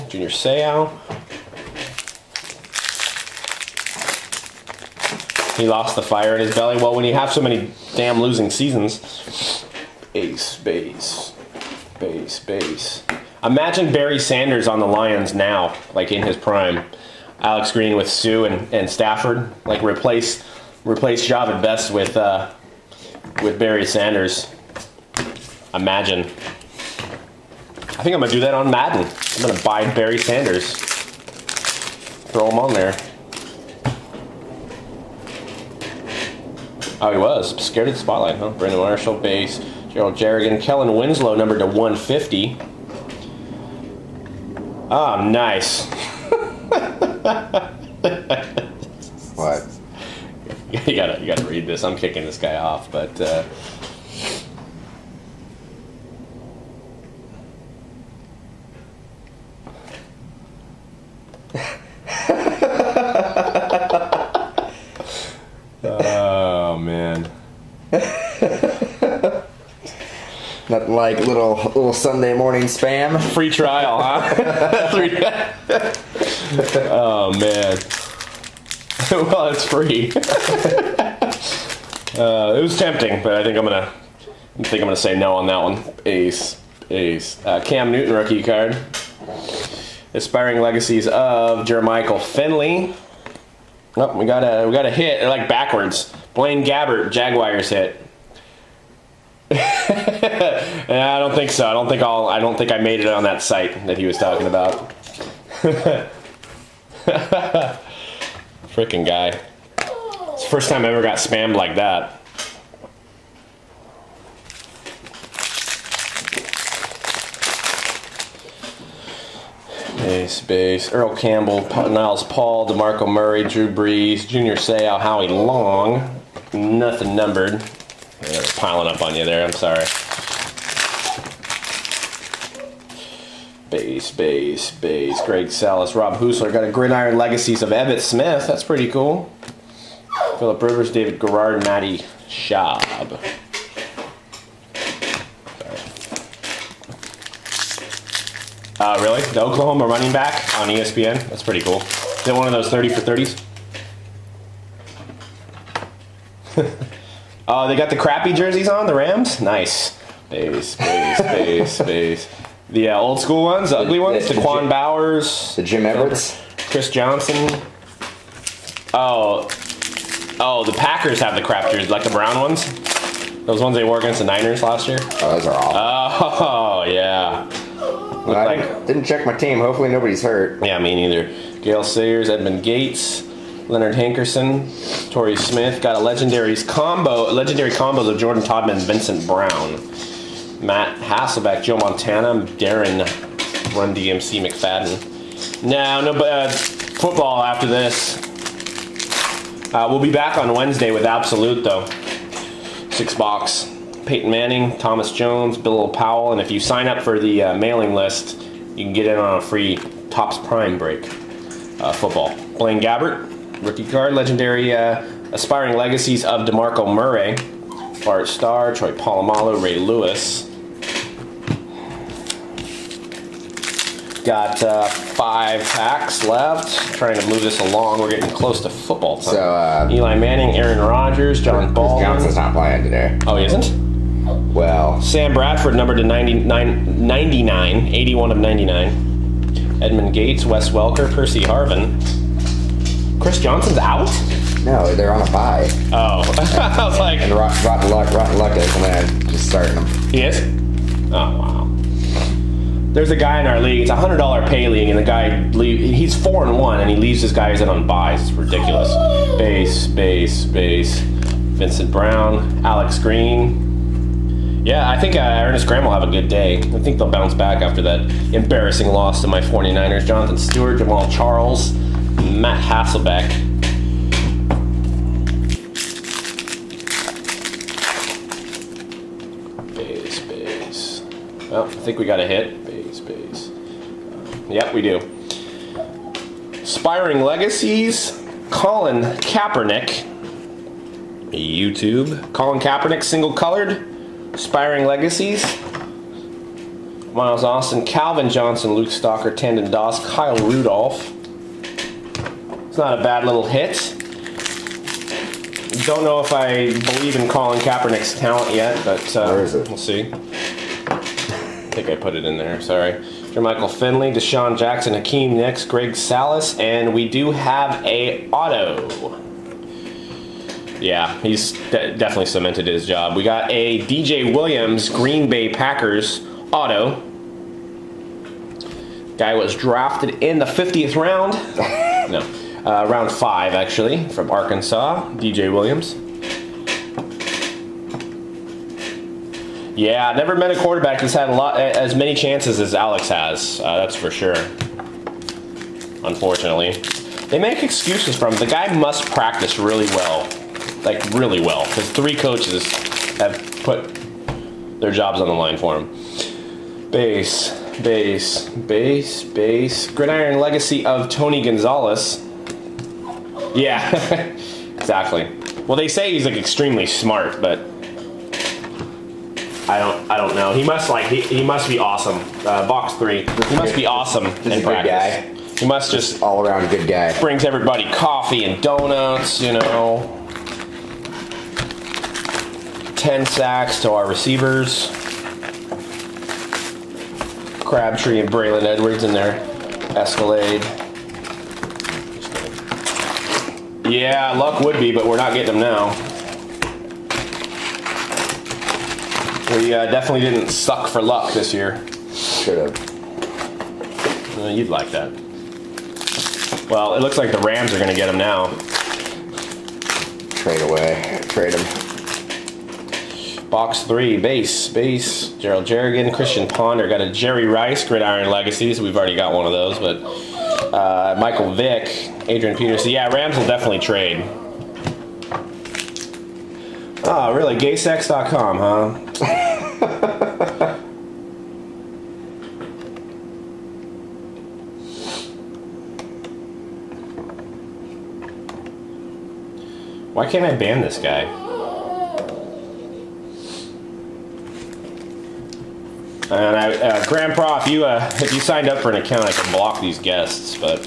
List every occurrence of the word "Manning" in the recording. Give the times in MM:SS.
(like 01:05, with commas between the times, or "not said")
03:24, 03:50.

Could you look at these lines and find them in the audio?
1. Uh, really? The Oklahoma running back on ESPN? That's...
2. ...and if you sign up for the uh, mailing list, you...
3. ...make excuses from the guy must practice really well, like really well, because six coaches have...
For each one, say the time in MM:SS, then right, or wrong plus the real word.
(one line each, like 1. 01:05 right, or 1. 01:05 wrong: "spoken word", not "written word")
1. 02:28 right
2. 03:26 right
3. 05:47 wrong: "three", not "six".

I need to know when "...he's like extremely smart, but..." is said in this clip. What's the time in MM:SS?
06:06.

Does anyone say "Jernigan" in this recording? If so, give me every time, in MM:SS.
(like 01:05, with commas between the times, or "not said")
00:40, 06:55.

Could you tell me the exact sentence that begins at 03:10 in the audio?
Matt Hasselbeck, Joe Montana, Darren Run DMC McFadden.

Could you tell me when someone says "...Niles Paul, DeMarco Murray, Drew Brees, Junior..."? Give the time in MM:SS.
02:01.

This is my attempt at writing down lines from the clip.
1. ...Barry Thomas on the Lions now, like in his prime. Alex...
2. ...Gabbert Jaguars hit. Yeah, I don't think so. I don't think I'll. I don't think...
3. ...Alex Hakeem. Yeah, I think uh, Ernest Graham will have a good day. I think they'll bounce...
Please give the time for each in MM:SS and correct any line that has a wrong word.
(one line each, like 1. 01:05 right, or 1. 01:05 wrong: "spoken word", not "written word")
1. 00:13 wrong: "Sanders", not "Thomas"
2. 01:36 right
3. 04:22 wrong: "Green", not "Hakeem".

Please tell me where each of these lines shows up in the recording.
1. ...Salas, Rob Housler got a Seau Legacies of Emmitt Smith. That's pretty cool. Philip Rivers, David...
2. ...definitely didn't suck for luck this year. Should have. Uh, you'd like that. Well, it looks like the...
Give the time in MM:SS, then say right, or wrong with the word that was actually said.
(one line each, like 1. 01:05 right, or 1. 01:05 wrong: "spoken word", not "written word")
1. 02:15 wrong: "Gridiron", not "Seau"
2. 06:39 right.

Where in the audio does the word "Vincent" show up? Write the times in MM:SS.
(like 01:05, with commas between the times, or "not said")
03:08, 04:21.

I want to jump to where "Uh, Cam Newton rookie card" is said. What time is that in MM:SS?
01:27.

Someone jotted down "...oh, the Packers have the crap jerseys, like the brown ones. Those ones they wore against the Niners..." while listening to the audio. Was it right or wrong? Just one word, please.
right.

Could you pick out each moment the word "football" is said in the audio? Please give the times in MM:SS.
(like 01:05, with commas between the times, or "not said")
03:16, 03:31, 03:48.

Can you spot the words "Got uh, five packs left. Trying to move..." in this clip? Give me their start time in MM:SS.
03:44.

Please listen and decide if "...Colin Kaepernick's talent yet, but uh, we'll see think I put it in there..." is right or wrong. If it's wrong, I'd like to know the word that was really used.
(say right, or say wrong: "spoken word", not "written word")
right.